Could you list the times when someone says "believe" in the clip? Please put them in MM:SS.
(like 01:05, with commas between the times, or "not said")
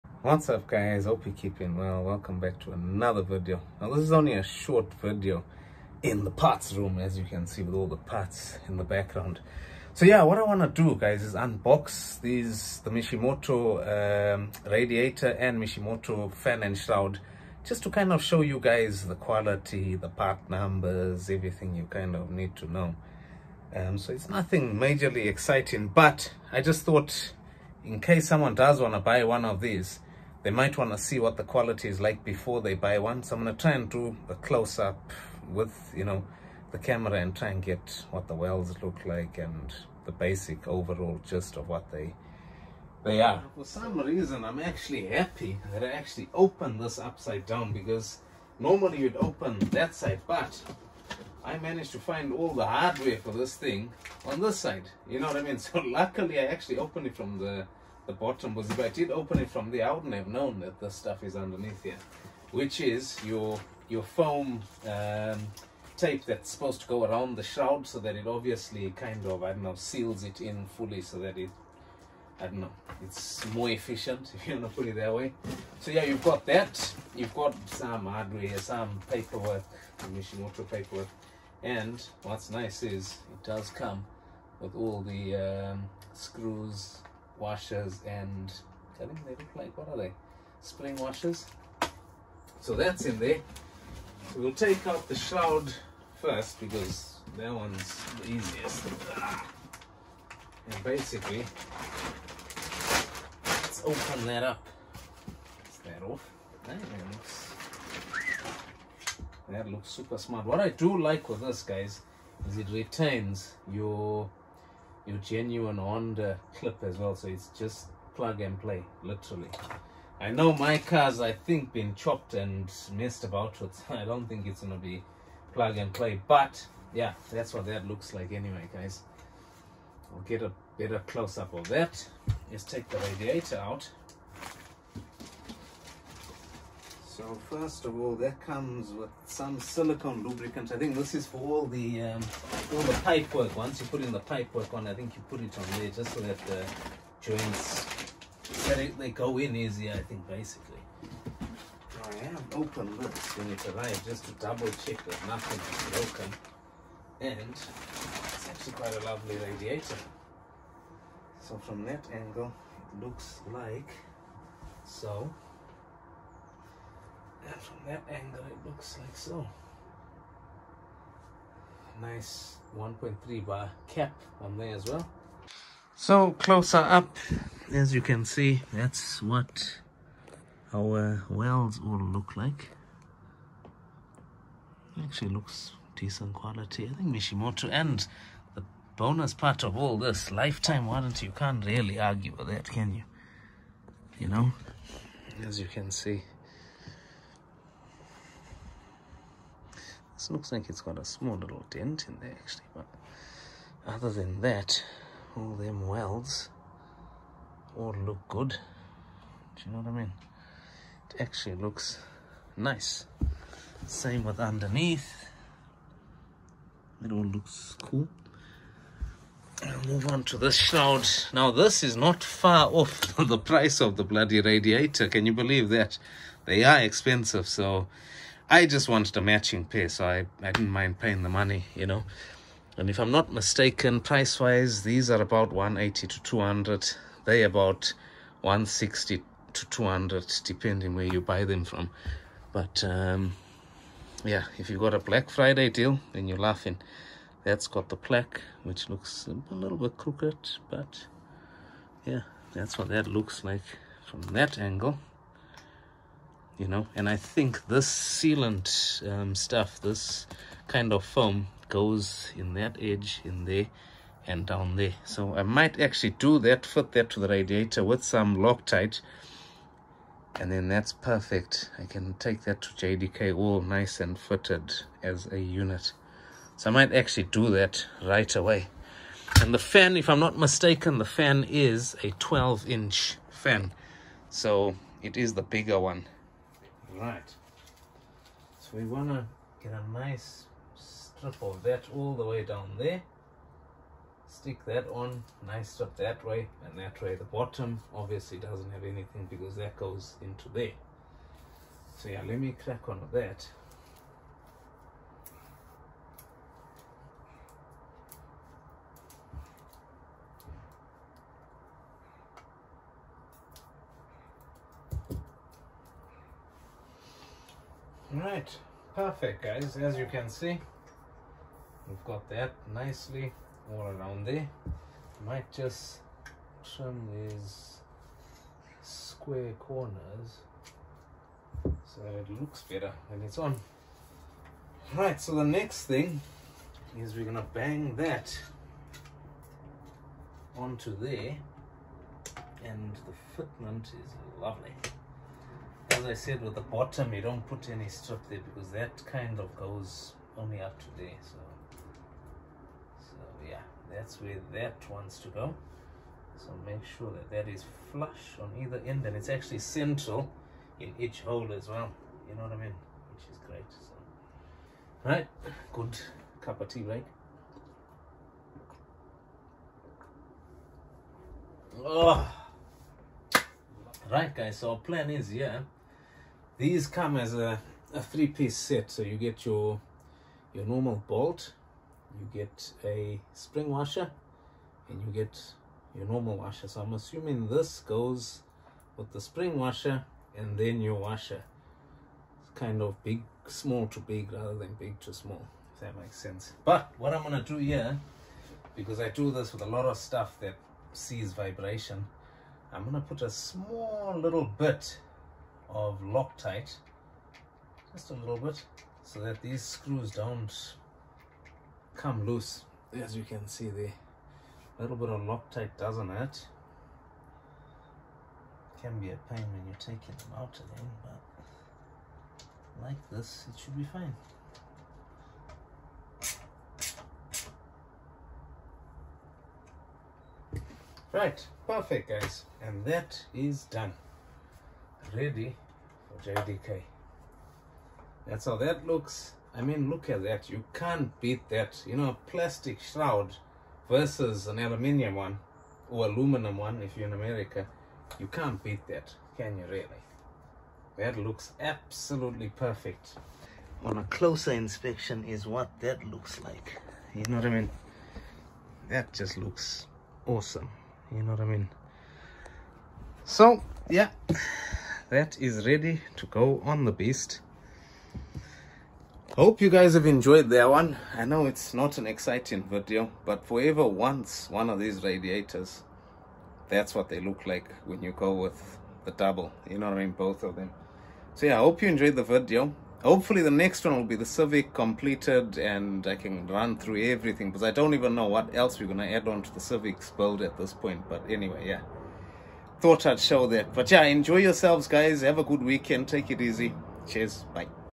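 03:45.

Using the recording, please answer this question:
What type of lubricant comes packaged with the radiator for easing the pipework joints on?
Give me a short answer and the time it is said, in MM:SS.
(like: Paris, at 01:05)
Silicone lubricant, at 02:19.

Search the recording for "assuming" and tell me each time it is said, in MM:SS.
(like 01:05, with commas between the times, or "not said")
06:26.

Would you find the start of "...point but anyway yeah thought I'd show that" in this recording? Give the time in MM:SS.
08:10.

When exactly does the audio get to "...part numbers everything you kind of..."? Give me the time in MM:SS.
00:20.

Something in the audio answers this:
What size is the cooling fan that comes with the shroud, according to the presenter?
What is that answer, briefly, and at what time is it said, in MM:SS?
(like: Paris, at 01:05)
12 inch, at 04:42.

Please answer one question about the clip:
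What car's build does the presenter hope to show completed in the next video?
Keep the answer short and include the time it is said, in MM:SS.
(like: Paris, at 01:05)
Civic, at 08:04.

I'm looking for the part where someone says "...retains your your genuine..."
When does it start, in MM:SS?
01:52.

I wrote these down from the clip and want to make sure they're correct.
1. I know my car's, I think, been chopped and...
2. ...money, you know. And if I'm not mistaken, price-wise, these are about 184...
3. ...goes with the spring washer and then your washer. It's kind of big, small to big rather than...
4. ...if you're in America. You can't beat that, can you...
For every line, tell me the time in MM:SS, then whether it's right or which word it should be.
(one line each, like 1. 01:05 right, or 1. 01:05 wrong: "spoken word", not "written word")
1. 02:00 right
2. 03:51 wrong: "180", not "184"
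3. 06:27 right
4. 07:26 right.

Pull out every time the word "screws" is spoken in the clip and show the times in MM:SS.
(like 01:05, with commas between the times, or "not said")
01:26, 06:49.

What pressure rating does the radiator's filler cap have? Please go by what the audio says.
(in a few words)
1.3 bar.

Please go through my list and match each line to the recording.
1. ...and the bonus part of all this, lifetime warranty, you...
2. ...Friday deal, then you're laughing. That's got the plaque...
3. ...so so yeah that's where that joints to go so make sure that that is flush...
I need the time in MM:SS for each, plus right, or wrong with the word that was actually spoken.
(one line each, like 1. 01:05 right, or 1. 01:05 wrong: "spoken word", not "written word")
1. 03:07 right
2. 04:05 right
3. 05:51 wrong: "wants", not "joints".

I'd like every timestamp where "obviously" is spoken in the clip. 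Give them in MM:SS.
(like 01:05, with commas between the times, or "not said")
01:08, 04:57.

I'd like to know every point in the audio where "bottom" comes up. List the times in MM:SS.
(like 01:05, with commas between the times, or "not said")
00:58, 04:57, 05:46.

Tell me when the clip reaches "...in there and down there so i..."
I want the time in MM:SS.
04:23.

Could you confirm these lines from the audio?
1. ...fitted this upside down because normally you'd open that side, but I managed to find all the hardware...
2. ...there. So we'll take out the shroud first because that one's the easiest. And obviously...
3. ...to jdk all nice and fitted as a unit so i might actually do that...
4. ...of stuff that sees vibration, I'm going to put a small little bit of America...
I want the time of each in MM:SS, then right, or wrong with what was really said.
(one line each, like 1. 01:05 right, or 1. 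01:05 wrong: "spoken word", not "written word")
1. 00:46 wrong: "opened", not "fitted"
2. 01:33 wrong: "basically", not "obviously"
3. 04:32 right
4. 06:39 wrong: "Loctite", not "America".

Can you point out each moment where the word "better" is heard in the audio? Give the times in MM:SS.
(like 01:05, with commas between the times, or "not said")
02:10, 05:32.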